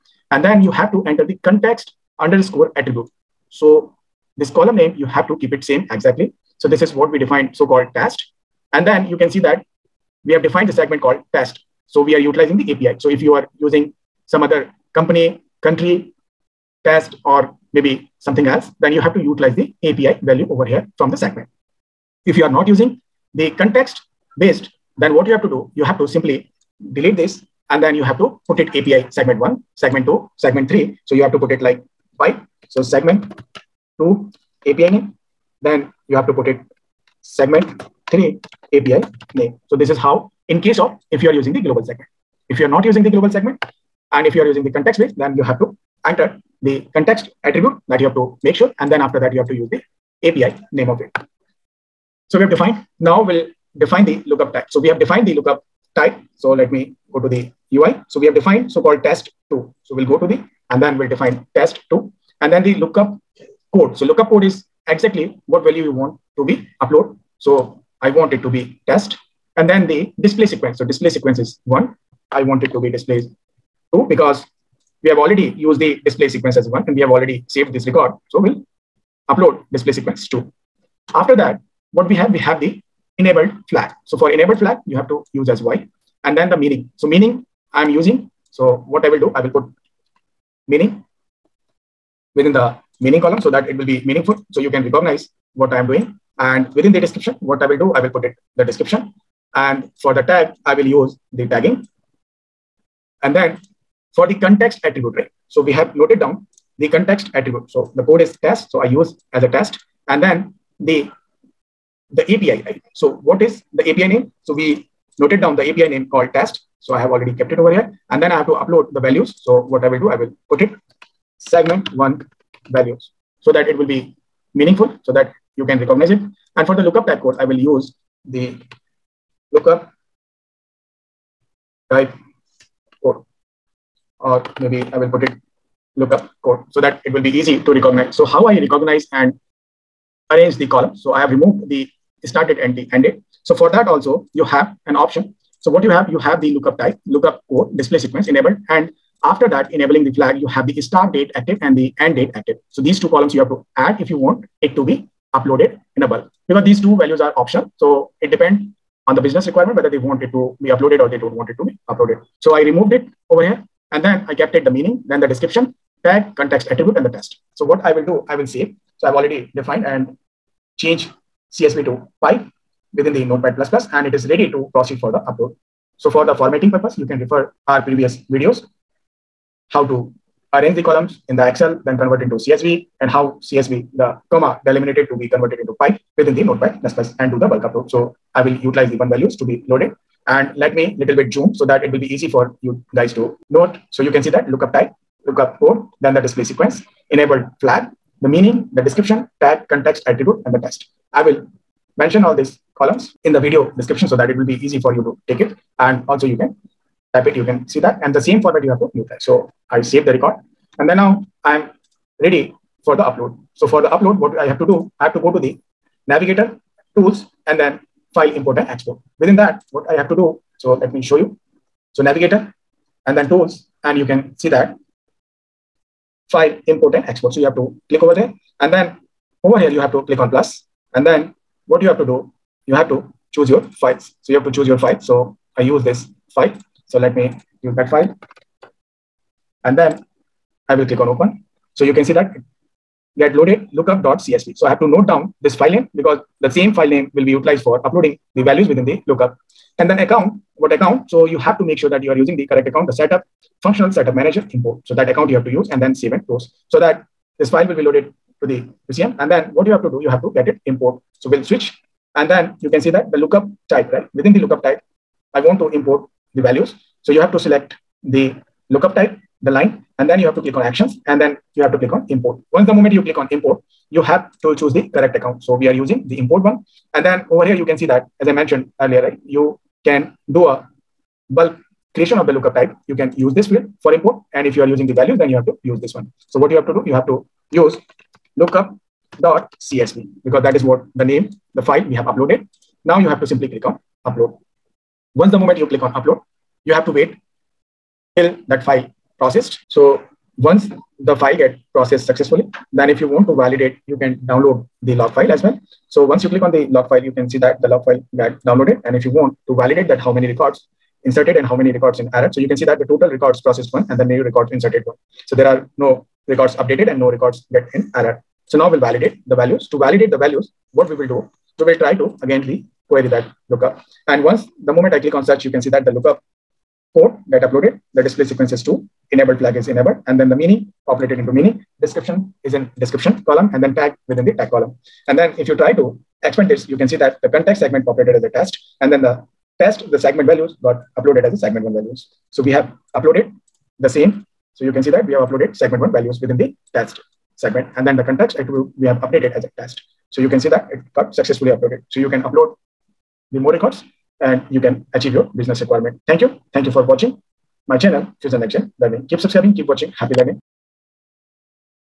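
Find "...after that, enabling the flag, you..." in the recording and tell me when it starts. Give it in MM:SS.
02:29.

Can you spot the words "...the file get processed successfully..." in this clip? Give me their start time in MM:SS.
05:00.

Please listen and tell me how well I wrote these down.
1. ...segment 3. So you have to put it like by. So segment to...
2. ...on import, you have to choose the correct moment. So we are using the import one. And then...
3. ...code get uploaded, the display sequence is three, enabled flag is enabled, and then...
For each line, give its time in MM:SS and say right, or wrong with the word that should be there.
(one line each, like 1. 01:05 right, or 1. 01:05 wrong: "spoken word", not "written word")
1. 00:30 right
2. 04:33 wrong: "account", not "moment"
3. 05:26 wrong: "two", not "three".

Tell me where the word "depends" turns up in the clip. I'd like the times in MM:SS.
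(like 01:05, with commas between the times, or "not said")
02:38.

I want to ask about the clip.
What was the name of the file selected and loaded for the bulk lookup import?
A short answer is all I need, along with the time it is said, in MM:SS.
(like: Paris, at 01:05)
lookup.csv, at 04:03.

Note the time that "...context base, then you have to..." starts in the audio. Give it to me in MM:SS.
00:44.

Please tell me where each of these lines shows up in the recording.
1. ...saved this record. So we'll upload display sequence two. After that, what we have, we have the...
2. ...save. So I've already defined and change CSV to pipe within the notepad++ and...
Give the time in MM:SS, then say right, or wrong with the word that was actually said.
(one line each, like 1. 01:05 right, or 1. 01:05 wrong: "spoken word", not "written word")
1. 01:17 right
2. 02:48 right.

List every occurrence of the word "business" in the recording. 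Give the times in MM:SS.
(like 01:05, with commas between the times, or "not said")
02:39, 05:55.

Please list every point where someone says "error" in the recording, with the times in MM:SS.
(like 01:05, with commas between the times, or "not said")
05:12, 05:17.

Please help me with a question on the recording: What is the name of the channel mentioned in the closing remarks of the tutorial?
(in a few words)
Fusion Nexgen learning.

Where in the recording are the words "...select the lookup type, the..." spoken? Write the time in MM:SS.
04:27.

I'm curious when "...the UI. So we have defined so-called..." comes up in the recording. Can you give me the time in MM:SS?
00:57.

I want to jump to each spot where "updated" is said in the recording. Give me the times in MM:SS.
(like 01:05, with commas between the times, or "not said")
05:16, 05:49.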